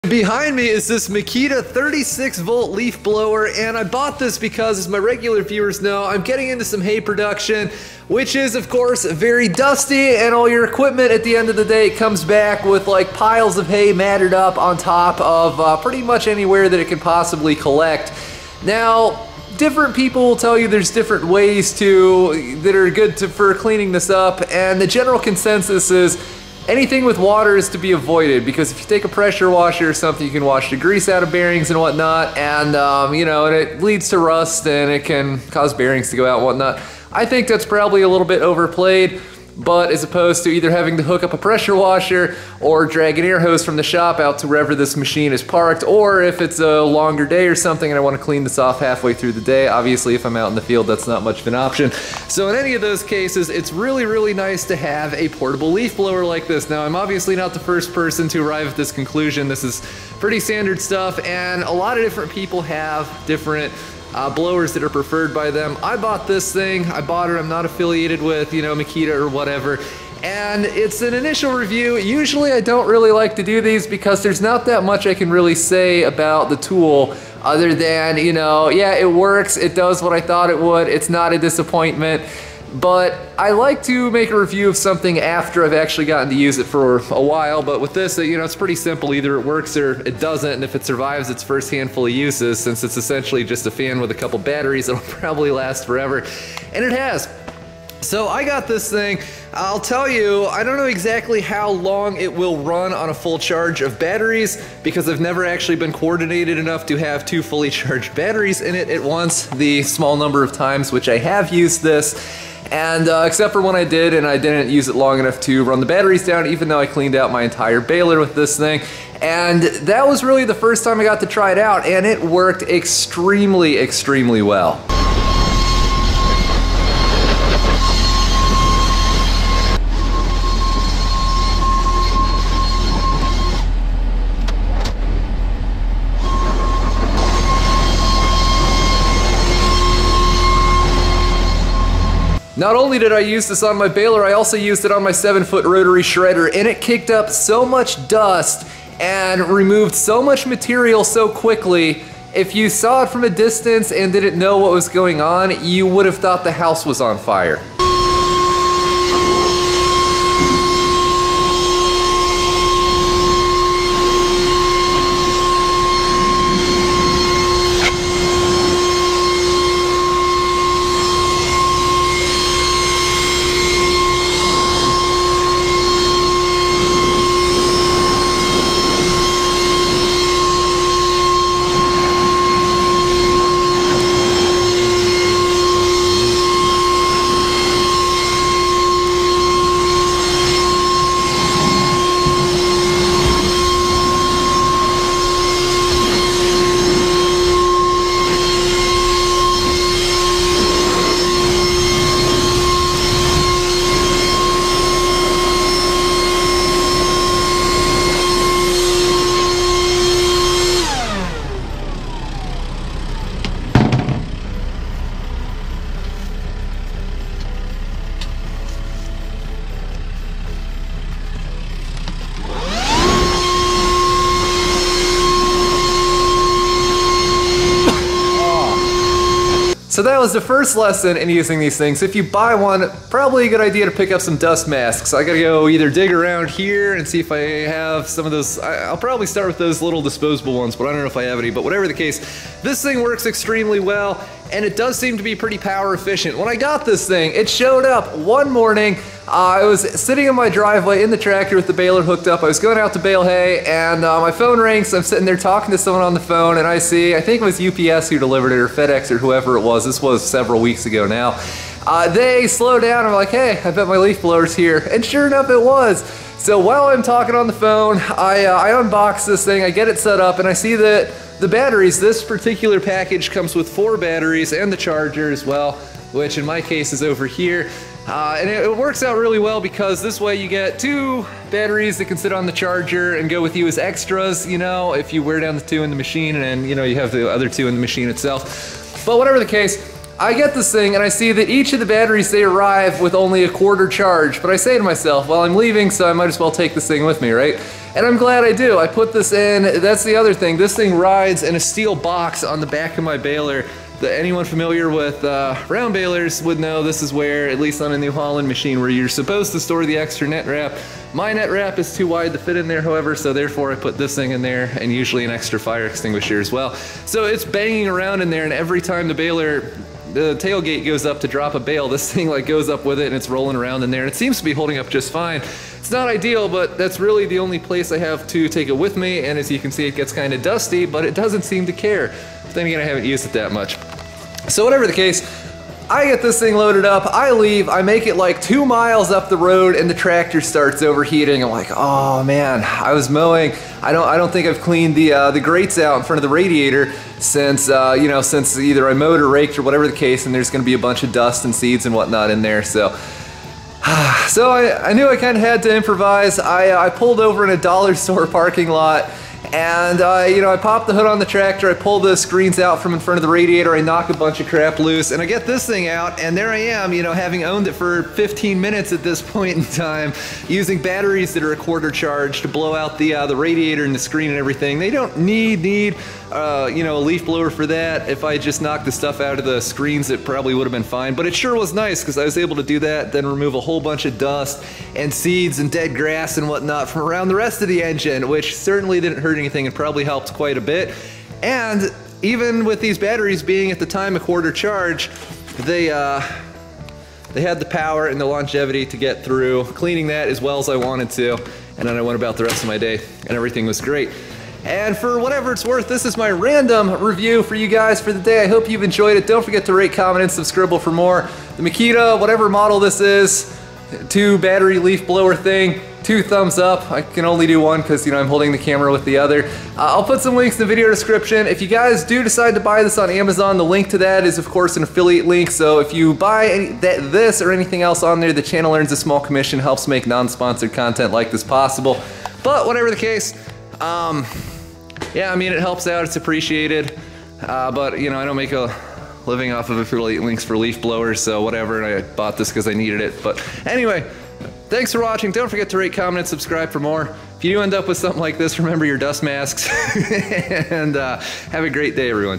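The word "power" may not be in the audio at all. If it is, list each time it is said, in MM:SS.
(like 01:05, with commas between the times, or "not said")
04:05, 06:37.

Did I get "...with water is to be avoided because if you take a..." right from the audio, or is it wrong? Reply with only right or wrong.
right.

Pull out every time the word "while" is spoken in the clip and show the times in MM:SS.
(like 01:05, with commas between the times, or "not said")
01:27, 04:26.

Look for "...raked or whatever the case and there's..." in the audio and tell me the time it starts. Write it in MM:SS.
05:49.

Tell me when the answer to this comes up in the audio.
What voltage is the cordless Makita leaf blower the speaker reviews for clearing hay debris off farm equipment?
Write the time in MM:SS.
00:01.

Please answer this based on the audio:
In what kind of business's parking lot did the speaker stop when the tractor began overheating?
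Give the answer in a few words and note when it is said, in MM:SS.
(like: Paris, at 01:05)
dollar store, at 05:57.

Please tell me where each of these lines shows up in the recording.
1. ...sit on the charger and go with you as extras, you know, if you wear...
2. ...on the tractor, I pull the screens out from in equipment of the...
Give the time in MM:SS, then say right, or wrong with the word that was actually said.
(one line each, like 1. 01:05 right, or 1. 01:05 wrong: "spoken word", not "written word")
1. 04:42 right
2. 06:01 wrong: "front", not "equipment".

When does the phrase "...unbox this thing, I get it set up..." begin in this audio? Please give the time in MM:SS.
04:28.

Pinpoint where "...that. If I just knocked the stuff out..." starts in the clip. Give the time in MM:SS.
06:17.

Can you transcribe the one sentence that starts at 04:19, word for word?
This was several weeks ago now.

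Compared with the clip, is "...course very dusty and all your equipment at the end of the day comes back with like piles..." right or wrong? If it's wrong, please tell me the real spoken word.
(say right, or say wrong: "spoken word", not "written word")
right.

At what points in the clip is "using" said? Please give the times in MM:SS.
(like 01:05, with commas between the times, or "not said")
03:51, 06:10.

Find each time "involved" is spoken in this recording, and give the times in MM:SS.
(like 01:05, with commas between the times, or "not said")
not said.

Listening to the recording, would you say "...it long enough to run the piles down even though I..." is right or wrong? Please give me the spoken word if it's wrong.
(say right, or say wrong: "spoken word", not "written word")
wrong: "batteries", not "piles".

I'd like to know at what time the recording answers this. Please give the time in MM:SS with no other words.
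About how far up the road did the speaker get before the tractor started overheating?
05:38.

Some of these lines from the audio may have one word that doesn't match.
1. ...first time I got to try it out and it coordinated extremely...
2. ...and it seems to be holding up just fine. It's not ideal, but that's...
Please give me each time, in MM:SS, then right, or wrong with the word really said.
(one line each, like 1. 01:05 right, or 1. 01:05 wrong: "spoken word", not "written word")
1. 02:00 wrong: "worked", not "coordinated"
2. 05:24 right.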